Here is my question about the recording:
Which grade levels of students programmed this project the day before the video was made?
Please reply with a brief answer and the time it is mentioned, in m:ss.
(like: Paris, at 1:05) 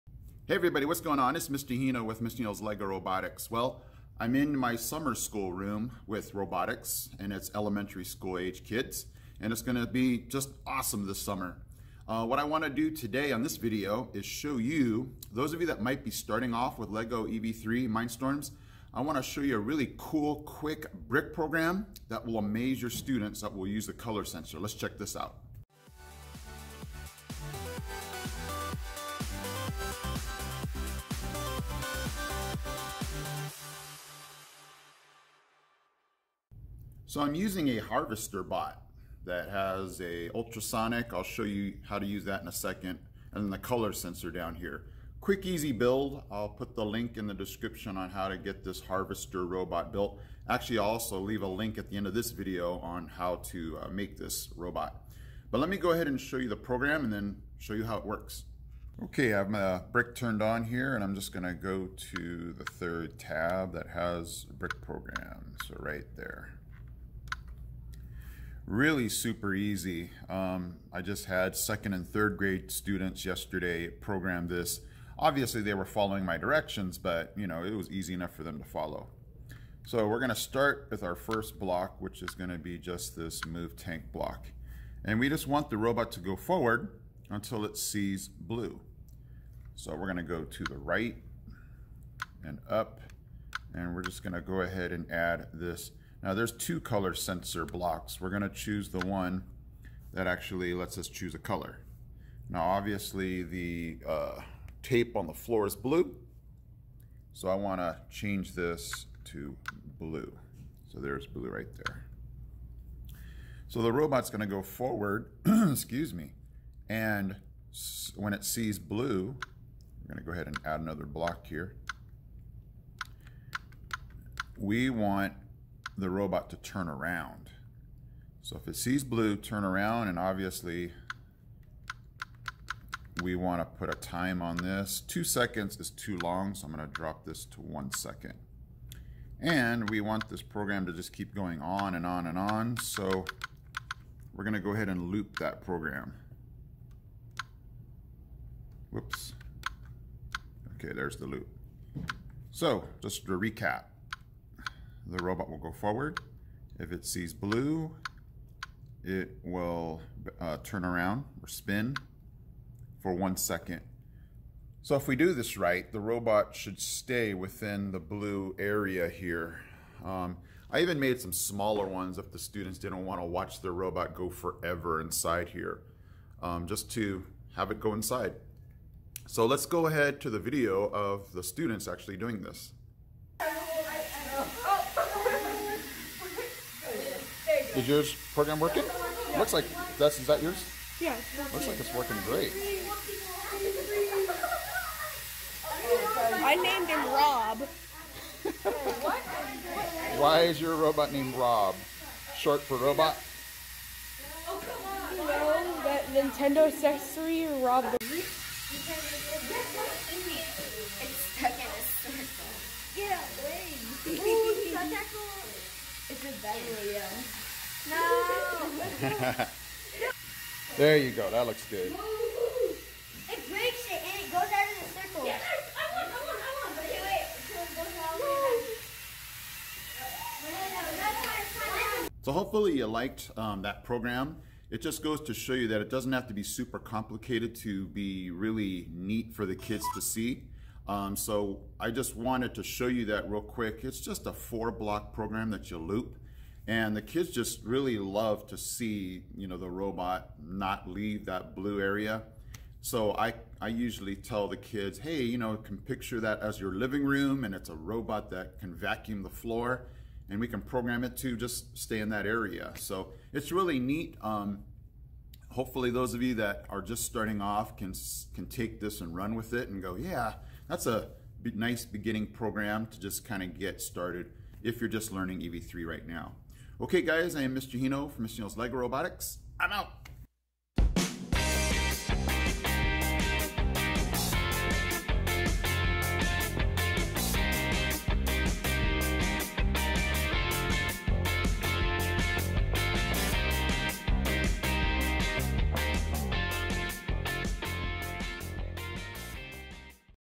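second and third grade, at 1:11.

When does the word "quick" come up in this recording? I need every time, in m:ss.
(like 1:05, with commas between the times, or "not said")
0:20, 0:45, 4:03.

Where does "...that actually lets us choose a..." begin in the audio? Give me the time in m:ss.
1:40.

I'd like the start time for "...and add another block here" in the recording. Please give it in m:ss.
2:00.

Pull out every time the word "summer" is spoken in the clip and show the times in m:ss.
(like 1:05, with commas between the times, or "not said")
0:04, 0:11.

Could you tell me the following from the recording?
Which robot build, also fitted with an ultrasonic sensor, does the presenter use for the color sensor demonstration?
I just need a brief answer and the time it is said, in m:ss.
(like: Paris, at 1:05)
harvester bot, at 0:37.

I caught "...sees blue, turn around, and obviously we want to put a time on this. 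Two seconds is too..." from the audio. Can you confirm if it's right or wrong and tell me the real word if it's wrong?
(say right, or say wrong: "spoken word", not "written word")
right.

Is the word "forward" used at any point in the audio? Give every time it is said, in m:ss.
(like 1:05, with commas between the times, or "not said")
1:26, 1:54, 2:35.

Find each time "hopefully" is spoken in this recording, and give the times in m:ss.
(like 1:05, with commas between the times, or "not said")
3:52, 4:25.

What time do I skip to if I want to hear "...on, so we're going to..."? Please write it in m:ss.
2:22.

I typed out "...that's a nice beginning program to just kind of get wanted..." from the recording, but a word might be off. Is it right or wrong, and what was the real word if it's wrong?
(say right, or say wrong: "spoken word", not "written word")
wrong: "started", not "wanted".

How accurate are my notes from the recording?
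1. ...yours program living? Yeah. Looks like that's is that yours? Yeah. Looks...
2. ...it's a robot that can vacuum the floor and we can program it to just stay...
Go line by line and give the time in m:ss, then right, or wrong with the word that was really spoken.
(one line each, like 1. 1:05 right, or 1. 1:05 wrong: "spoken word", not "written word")
1. 3:07 wrong: "working", not "living"
2. 4:17 right.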